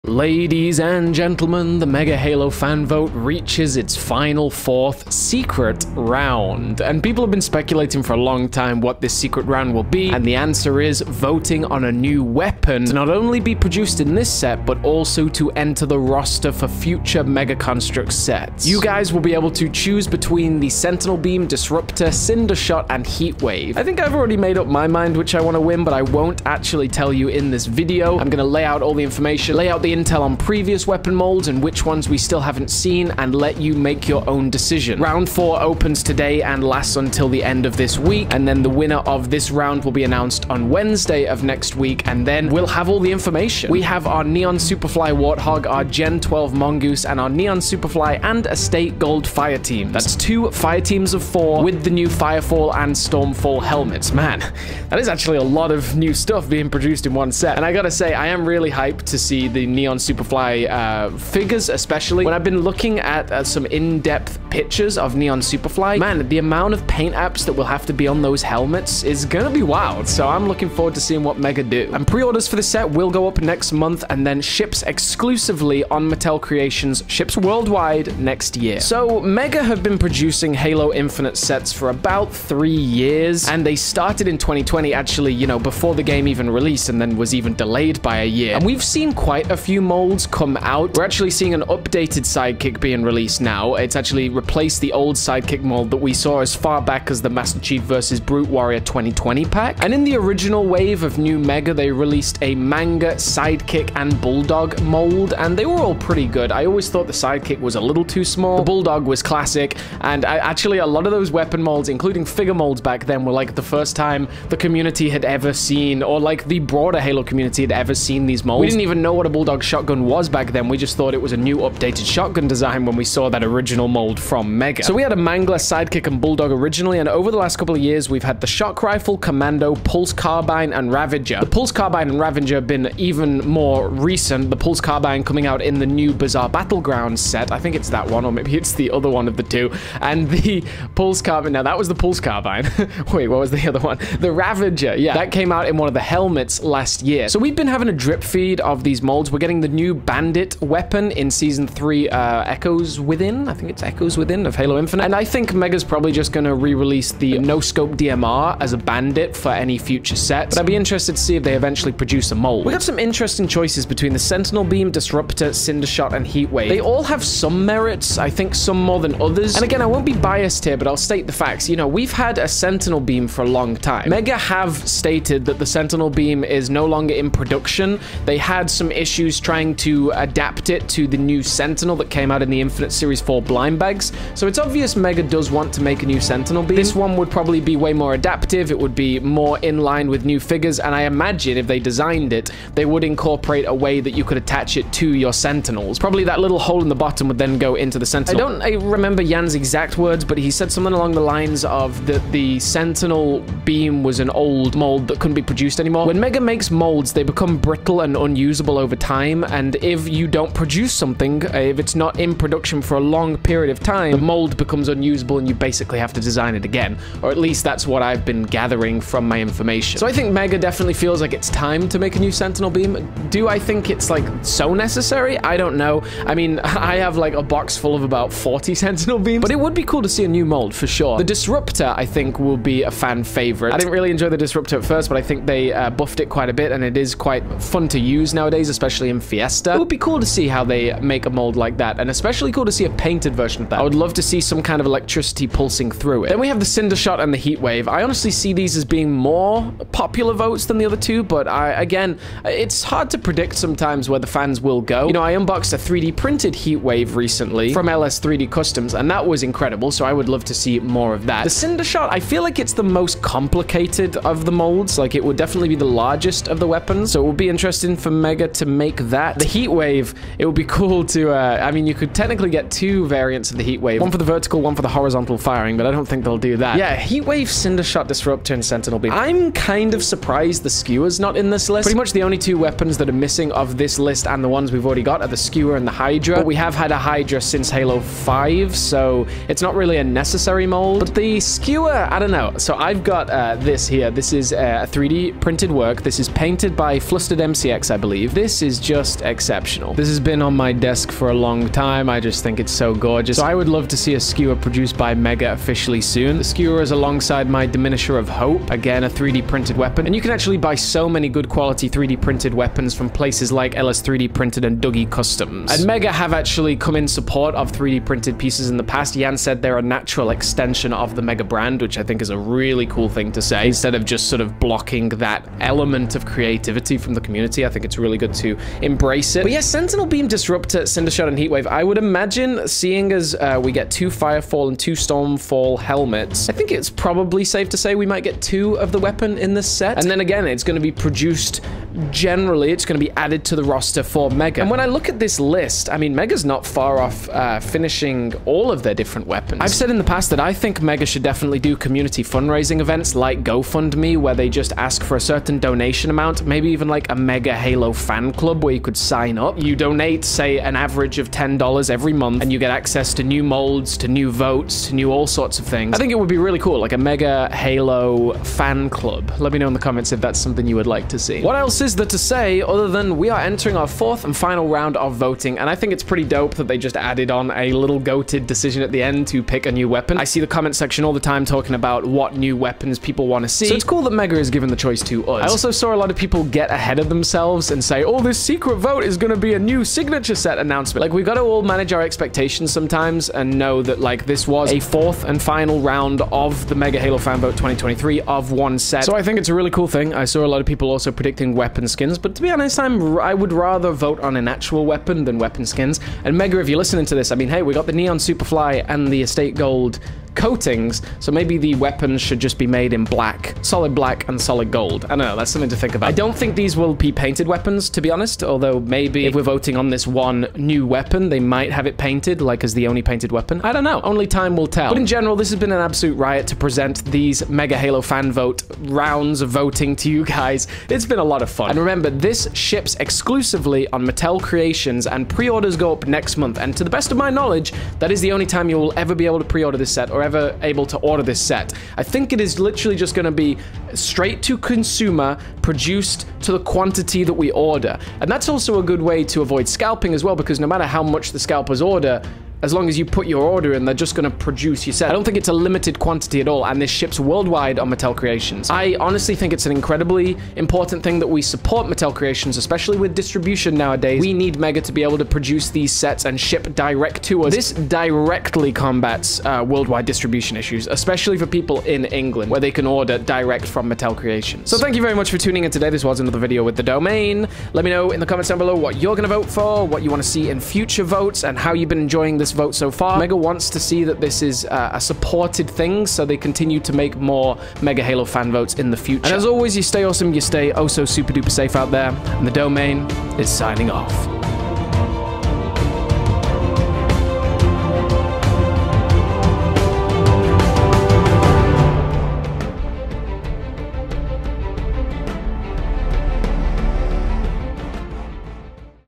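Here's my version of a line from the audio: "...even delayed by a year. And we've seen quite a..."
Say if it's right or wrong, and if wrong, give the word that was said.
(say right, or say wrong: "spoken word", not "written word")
right.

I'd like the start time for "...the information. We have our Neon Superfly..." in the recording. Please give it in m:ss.
0:43.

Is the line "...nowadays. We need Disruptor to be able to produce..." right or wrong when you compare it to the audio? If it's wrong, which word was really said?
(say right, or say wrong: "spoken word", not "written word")
wrong: "Mega", not "Disruptor".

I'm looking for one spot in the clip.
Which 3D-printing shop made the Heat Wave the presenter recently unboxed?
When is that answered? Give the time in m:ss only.
4:17.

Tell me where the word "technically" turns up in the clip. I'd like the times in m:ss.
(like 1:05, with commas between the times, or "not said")
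4:32.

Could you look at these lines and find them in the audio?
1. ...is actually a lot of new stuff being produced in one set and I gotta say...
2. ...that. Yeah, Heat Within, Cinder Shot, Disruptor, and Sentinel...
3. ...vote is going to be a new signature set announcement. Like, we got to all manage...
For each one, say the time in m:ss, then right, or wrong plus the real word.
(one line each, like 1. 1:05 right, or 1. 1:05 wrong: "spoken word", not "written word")
1. 0:54 right
2. 4:36 wrong: "Wave", not "Within"
3. 6:28 right.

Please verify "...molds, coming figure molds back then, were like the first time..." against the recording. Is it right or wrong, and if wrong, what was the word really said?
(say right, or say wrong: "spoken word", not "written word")
wrong: "including", not "coming".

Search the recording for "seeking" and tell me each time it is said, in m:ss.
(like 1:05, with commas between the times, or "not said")
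not said.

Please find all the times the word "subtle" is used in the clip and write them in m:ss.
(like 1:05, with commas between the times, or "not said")
not said.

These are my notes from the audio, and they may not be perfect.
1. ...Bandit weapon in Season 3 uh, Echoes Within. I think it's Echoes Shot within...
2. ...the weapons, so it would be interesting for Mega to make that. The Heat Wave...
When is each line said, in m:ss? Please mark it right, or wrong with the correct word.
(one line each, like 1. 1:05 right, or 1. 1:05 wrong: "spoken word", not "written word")
1. 2:29 wrong: "Within", not "Shot"
2. 4:26 right.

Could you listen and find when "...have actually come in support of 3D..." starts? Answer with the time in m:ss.
5:16.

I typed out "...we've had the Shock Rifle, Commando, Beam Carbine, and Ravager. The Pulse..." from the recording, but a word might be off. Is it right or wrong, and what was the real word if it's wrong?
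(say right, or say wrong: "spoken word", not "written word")
wrong: "Pulse", not "Beam".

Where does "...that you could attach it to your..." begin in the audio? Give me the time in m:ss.
3:14.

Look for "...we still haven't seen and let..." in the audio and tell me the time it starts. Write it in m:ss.
0:32.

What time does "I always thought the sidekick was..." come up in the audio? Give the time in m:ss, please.
1:46.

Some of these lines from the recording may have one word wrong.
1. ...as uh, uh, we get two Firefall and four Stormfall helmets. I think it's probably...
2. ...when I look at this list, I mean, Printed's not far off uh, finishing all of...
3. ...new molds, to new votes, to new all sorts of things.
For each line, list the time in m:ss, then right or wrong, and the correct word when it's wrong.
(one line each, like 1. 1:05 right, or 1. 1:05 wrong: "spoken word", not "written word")
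1. 5:33 wrong: "two", not "four"
2. 5:44 wrong: "Mega", not "Printed"
3. 6:03 right.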